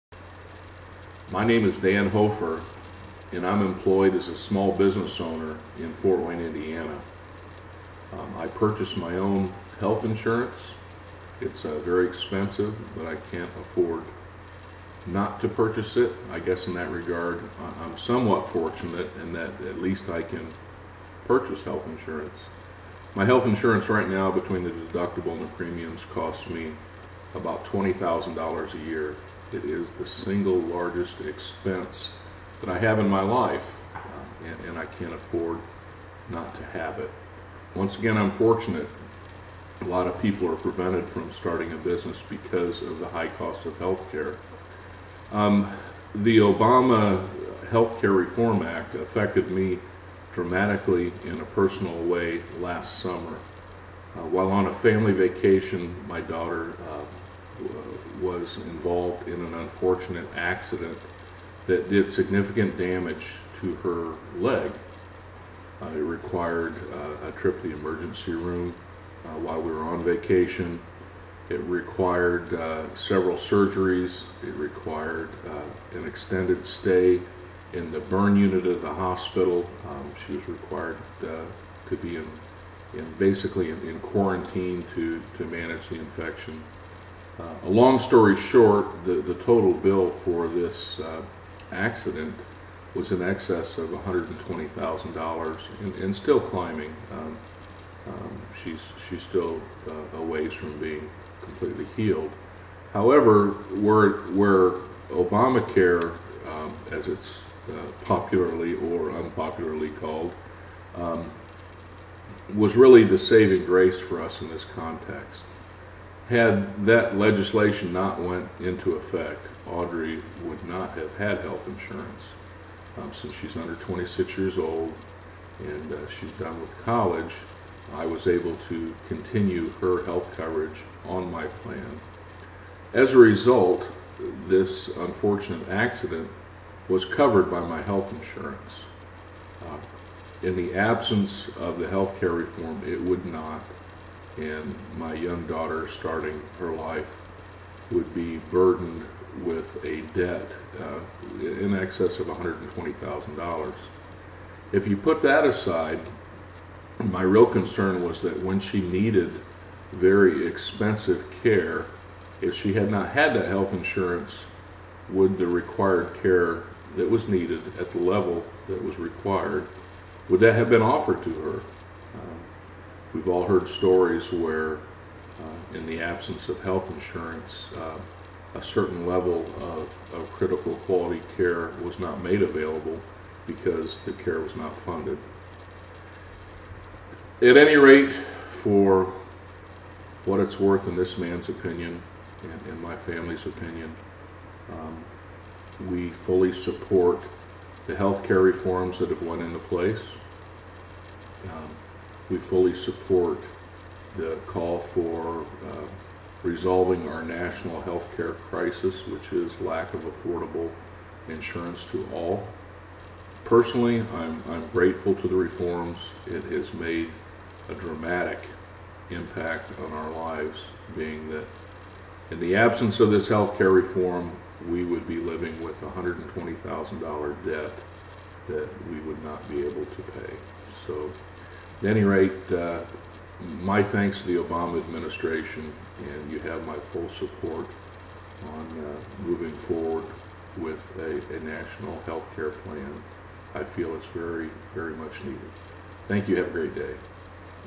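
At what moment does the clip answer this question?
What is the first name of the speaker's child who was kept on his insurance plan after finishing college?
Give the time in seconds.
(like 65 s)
119 s.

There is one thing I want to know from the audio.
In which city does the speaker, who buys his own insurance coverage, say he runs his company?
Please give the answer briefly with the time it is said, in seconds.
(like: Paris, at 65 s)
Fort Wayne, at 5 s.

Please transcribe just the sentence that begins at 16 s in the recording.
I guess in that regard, I'm somewhat fortunate in that at least I can purchase health insurance.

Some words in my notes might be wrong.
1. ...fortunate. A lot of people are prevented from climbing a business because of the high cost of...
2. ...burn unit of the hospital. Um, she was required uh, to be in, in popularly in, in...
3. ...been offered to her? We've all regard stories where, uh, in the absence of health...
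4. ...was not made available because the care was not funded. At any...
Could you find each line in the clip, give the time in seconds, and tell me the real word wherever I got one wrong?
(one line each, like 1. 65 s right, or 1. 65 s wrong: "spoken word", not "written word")
1. 38 s wrong: "starting", not "climbing"
2. 78 s wrong: "basically", not "popularly"
3. 170 s wrong: "heard", not "regard"
4. 181 s right.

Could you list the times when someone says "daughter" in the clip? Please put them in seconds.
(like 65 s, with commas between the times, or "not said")
56 s, 145 s.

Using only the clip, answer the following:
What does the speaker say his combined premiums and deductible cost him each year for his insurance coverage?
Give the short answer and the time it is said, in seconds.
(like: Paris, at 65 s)
$20,000, at 27 s.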